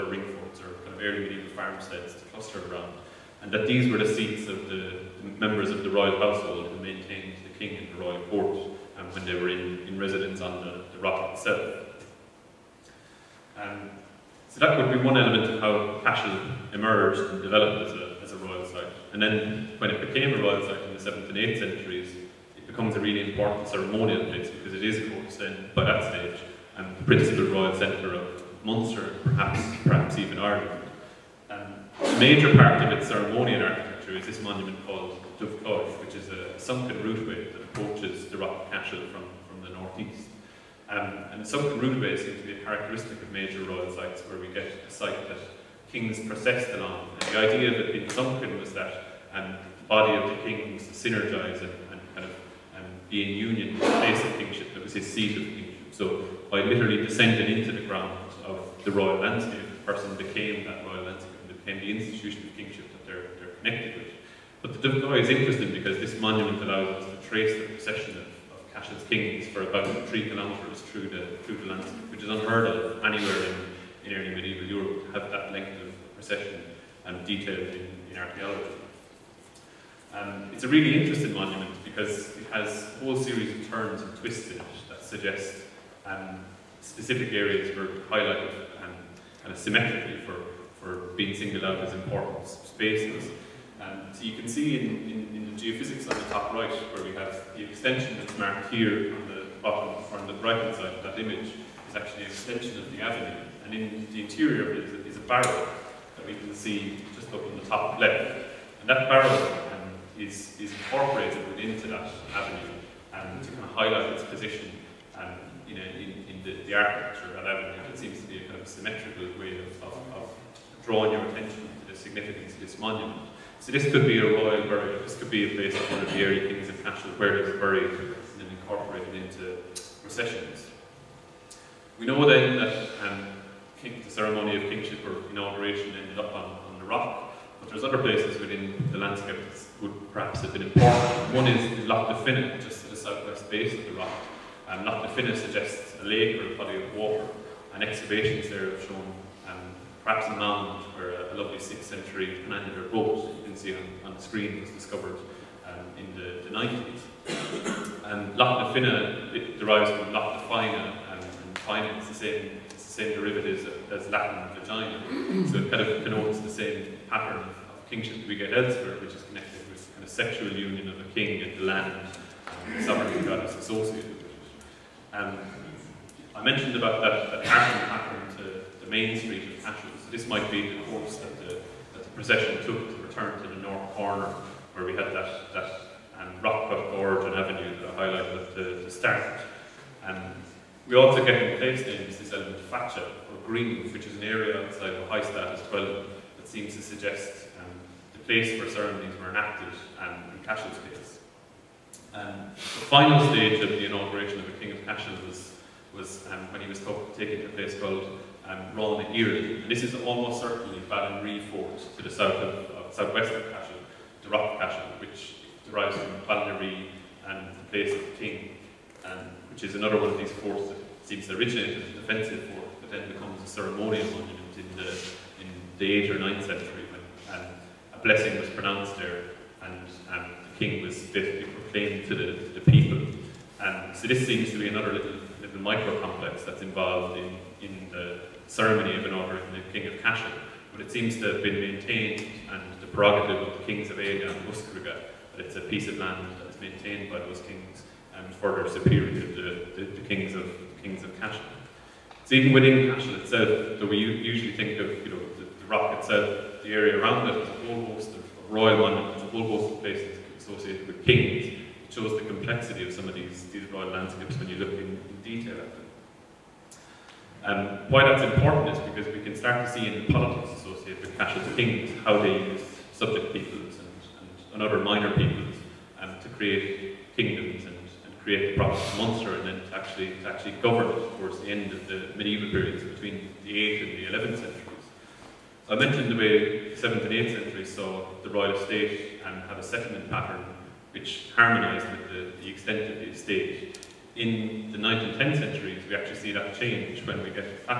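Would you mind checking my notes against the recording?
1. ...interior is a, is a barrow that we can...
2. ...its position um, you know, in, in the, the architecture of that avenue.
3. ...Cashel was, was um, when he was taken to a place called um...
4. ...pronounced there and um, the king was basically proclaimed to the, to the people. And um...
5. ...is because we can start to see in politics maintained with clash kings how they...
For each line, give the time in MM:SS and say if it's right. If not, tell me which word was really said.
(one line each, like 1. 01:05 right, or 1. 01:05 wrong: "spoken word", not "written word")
1. 01:44 right
2. 01:54 right
3. 03:24 right
4. 03:48 right
5. 04:28 wrong: "associated", not "maintained".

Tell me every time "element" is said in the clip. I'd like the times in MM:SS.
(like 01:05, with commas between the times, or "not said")
00:15, 03:12.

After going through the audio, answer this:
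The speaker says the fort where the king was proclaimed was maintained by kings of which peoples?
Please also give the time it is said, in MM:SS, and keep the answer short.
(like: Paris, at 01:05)
Aga and Muscraige, at 04:03.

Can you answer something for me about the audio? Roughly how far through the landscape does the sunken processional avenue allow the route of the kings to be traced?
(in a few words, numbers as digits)
3 kilometres.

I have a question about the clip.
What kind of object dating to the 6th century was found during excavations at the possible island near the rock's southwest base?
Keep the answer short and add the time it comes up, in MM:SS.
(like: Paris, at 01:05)
Penannular brooch, at 02:32.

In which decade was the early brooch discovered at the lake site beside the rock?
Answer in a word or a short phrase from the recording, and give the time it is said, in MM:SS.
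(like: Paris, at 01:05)
1990s, at 02:36.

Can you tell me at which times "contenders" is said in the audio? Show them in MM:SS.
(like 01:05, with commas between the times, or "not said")
not said.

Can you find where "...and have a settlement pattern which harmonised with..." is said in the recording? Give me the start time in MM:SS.
04:49.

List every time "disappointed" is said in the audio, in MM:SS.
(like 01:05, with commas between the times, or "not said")
not said.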